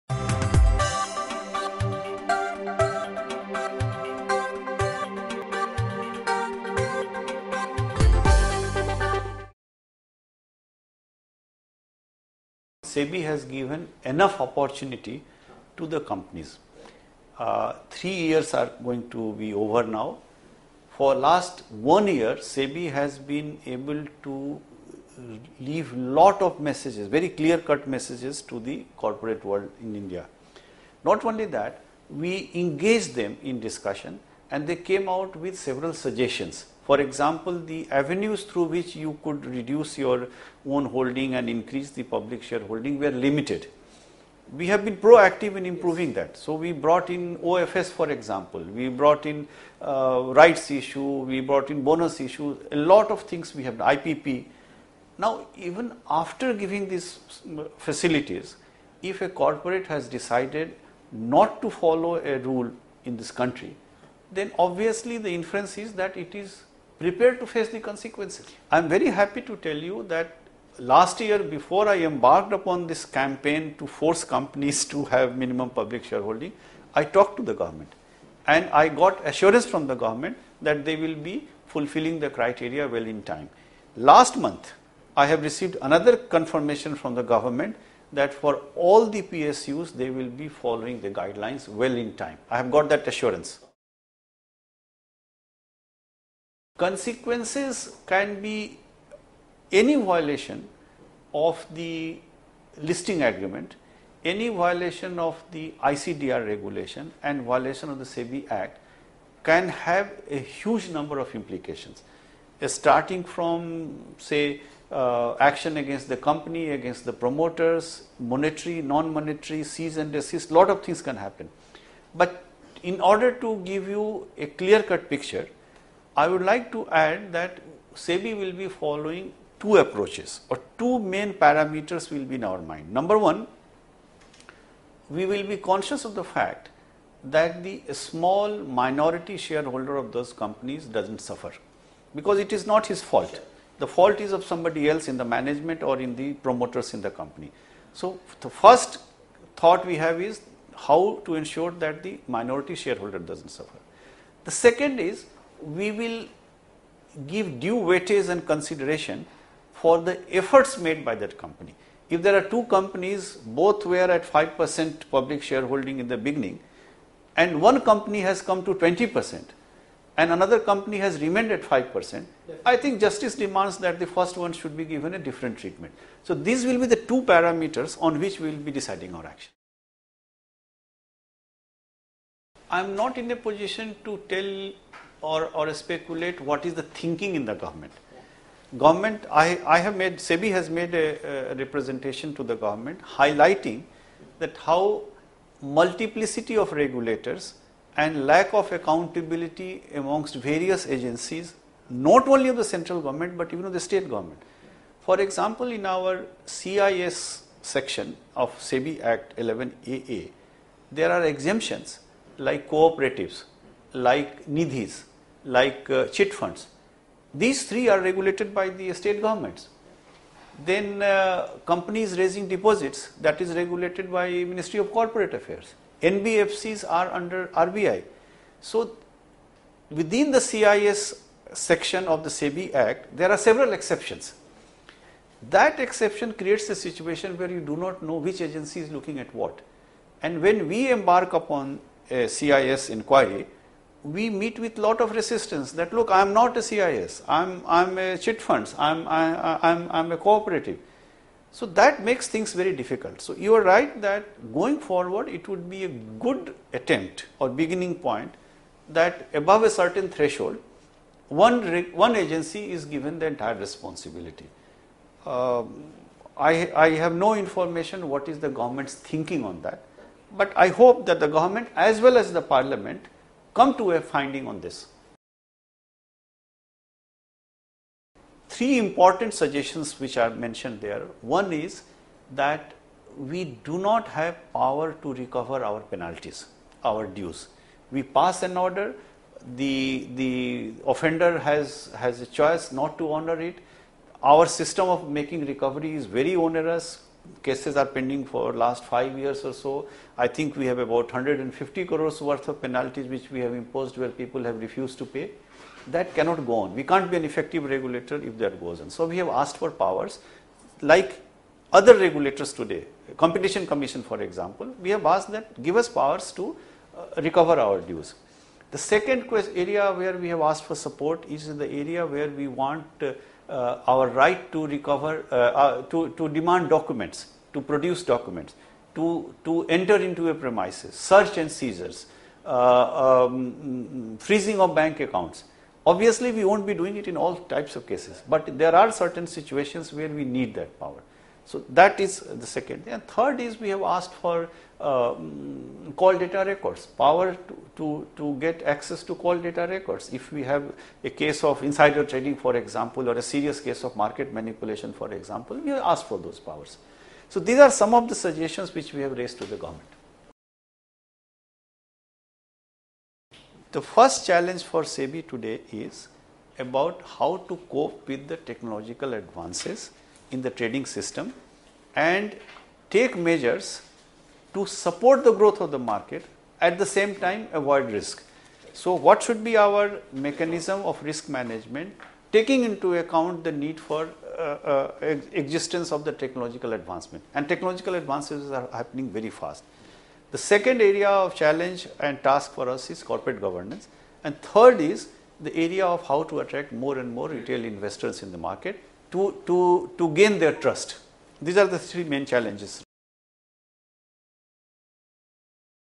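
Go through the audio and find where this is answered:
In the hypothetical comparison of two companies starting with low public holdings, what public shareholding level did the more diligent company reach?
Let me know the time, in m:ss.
2:48.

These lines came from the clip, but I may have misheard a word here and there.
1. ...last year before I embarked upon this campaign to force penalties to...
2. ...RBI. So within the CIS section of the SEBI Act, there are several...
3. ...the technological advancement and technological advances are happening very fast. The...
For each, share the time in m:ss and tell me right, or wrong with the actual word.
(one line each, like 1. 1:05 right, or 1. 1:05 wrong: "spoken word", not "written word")
1. 1:10 wrong: "companies", not "penalties"
2. 3:47 right
3. 6:26 right.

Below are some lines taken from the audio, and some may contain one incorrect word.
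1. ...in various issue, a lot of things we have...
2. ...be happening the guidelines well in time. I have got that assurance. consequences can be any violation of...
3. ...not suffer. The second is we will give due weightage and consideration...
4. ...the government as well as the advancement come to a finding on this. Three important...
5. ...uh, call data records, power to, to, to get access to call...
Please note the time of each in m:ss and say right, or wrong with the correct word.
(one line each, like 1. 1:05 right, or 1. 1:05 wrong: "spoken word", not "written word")
1. 0:51 wrong: "bonus", not "various"
2. 1:30 wrong: "following", not "happening"
3. 2:33 right
4. 4:31 wrong: "parliament", not "advancement"
5. 5:44 right.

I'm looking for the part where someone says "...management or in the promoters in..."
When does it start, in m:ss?
2:25.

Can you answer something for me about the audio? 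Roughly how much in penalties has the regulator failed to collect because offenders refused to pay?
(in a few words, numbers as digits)
150 crores.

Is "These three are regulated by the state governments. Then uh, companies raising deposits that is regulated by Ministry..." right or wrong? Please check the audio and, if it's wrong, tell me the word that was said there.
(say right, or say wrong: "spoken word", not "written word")
right.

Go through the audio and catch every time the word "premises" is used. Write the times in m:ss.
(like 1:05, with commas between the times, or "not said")
5:30.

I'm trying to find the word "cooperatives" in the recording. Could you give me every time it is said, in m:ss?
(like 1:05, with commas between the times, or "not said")
3:32, 4:10.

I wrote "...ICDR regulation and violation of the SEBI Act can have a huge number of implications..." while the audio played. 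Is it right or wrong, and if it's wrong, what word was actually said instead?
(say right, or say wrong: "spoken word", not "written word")
right.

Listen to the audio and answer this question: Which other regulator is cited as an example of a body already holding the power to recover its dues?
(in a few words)
Competition Commission.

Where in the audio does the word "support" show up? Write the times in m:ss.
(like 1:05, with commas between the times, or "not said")
5:20, 6:14.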